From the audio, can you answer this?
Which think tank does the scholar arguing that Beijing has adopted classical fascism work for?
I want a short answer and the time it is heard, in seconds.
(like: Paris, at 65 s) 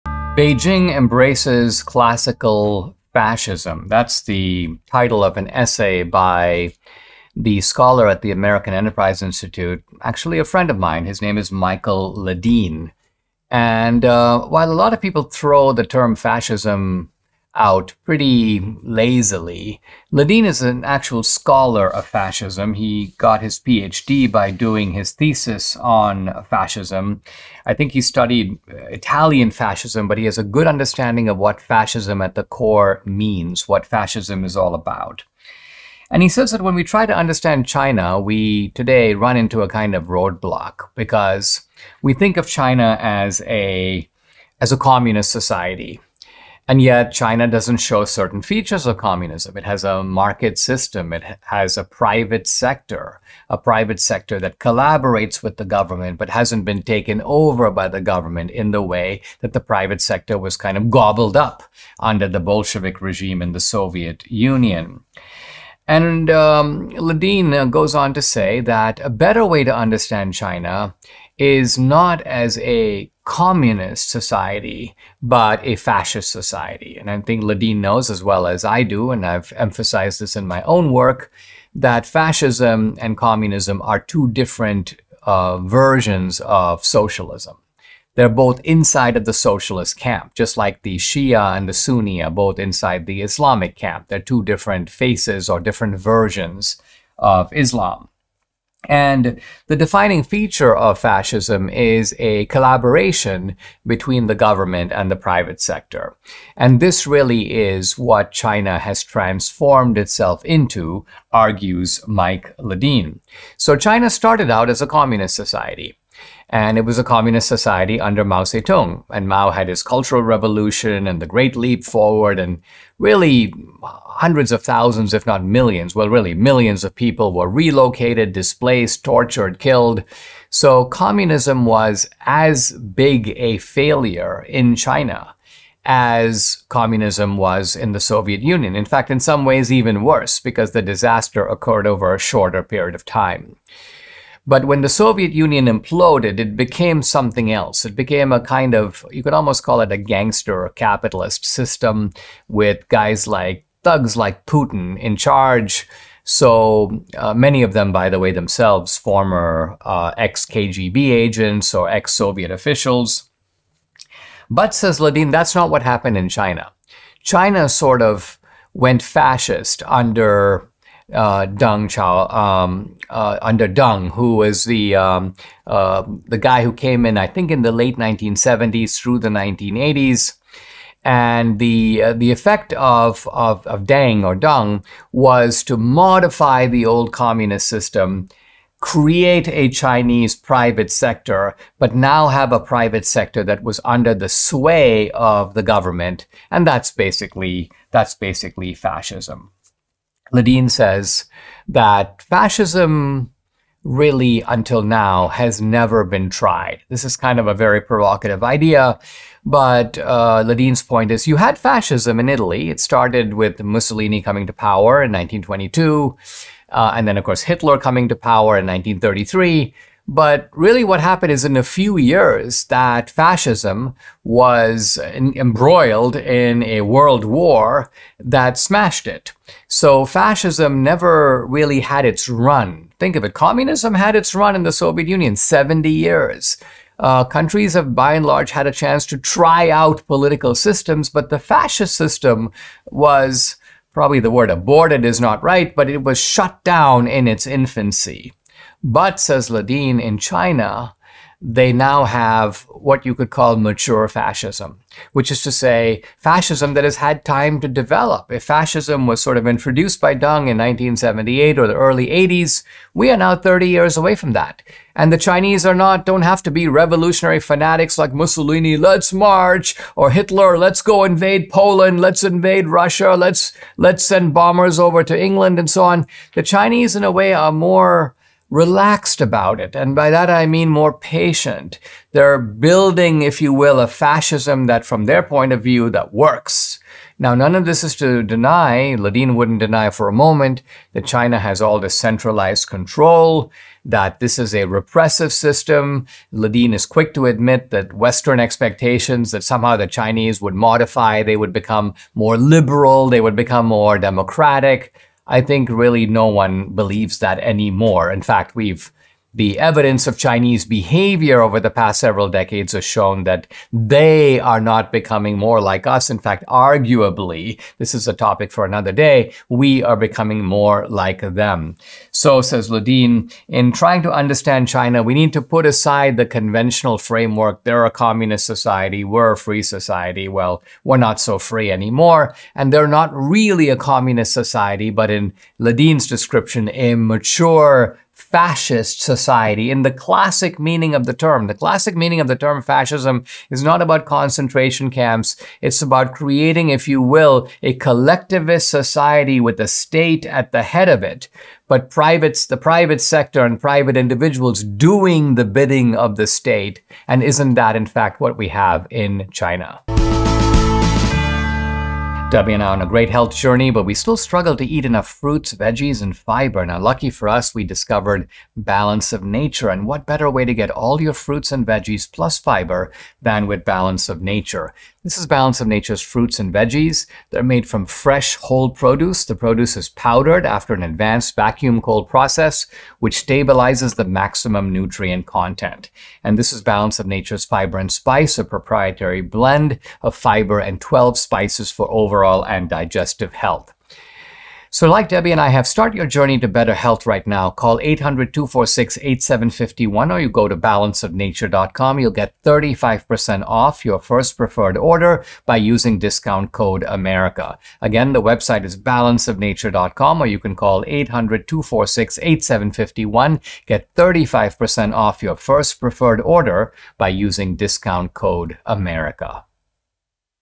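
American Enterprise Institute, at 8 s.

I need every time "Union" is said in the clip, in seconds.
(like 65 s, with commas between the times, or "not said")
64 s, 138 s, 145 s, 235 s.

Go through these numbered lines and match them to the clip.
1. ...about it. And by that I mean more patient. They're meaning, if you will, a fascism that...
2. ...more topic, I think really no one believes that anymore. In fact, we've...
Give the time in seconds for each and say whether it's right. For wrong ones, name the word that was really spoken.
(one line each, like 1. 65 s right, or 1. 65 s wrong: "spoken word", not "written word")
1. 279 s wrong: "building", not "meaning"
2. 303 s wrong: "democratic", not "topic".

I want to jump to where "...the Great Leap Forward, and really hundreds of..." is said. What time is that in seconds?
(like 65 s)
121 s.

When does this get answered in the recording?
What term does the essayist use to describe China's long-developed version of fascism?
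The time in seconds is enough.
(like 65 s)
253 s.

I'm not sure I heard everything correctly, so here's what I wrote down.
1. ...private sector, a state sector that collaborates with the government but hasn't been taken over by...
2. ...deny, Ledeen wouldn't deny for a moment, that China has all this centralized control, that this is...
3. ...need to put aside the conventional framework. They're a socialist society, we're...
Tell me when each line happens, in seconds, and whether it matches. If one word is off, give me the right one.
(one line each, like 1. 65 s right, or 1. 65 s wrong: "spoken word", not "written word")
1. 51 s wrong: "private", not "state"
2. 288 s right
3. 325 s wrong: "communist", not "socialist".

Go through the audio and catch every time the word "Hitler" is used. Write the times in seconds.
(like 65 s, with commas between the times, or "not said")
217 s, 270 s.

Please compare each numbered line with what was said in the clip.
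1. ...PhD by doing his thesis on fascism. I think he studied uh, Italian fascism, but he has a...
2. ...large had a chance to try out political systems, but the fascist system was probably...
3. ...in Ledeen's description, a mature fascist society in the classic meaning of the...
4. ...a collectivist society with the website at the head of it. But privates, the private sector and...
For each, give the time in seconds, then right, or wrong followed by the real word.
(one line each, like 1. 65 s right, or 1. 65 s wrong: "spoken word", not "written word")
1. 23 s right
2. 238 s right
3. 335 s right
4. 347 s wrong: "state", not "website".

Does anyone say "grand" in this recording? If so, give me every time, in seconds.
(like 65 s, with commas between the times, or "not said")
not said.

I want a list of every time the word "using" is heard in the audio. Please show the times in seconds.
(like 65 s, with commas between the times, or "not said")
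405 s, 417 s.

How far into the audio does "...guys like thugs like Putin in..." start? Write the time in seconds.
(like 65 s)
152 s.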